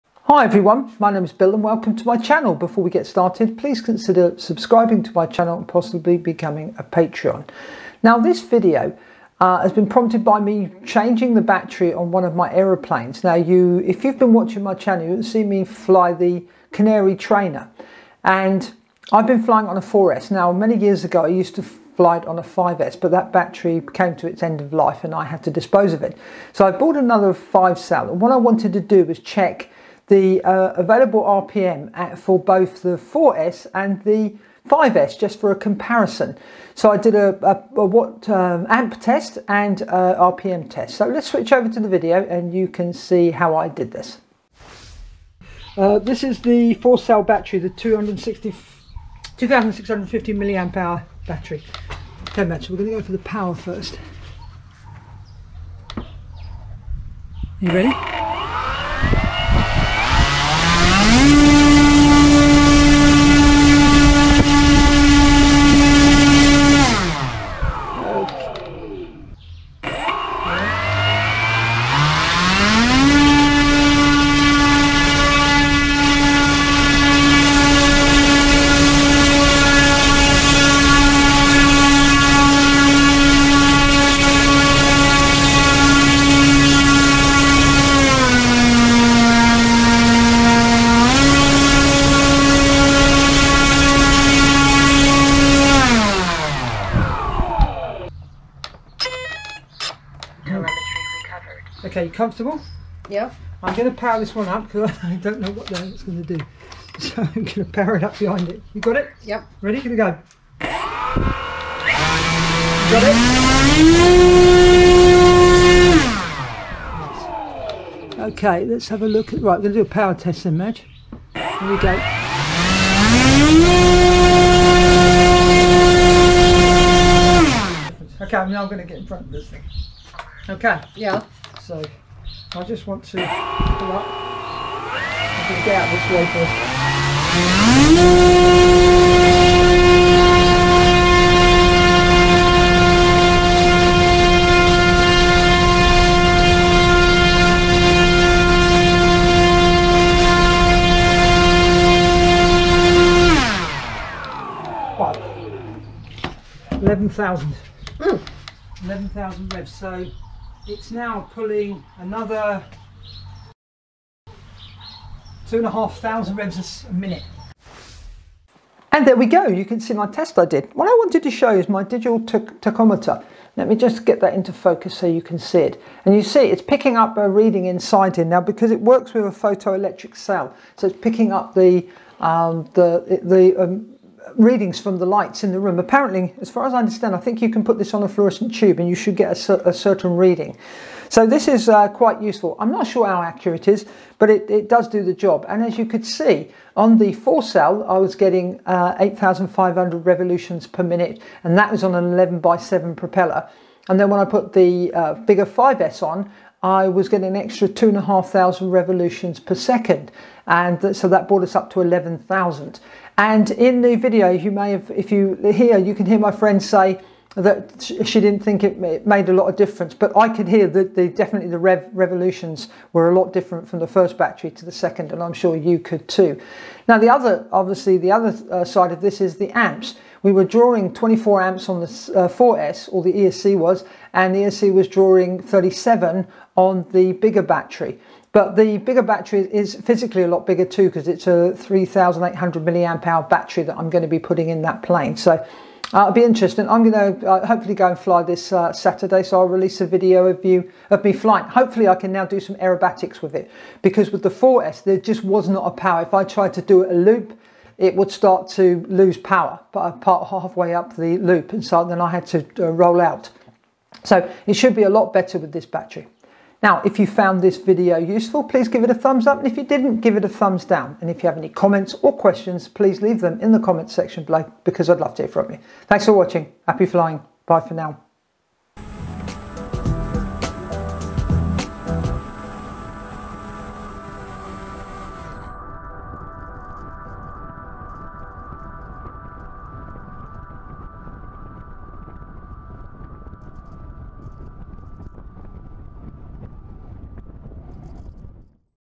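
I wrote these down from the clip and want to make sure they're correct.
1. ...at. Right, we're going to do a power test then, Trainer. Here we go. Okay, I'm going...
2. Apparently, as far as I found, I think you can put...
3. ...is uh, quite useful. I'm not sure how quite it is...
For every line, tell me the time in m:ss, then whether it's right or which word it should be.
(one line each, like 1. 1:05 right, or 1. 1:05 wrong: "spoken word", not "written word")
1. 1:59 wrong: "Madge", not "Trainer"
2. 3:05 wrong: "understand", not "found"
3. 3:11 wrong: "accurate", not "quite".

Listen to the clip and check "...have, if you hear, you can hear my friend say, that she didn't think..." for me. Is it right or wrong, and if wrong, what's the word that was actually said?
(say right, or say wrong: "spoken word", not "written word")
right.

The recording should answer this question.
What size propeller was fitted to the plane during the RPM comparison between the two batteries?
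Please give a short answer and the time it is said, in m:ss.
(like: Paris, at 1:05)
11 by 7, at 3:22.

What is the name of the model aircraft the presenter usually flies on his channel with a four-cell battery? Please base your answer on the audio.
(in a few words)
Canary Trainer.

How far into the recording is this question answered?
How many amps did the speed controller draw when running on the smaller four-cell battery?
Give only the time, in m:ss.
3:50.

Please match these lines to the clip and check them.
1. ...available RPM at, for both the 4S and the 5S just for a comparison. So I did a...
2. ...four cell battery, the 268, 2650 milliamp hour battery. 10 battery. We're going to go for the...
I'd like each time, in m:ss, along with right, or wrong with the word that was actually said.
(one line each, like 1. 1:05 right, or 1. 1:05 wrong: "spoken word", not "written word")
1. 0:30 right
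2. 0:46 wrong: "260", not "268".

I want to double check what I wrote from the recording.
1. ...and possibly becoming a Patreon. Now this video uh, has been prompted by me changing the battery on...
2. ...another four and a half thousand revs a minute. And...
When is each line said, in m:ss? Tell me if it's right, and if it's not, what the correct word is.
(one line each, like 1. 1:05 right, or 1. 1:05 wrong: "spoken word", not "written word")
1. 0:05 right
2. 2:41 wrong: "two", not "four".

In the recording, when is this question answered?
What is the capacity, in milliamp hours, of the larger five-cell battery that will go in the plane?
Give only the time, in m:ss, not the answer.
4:01.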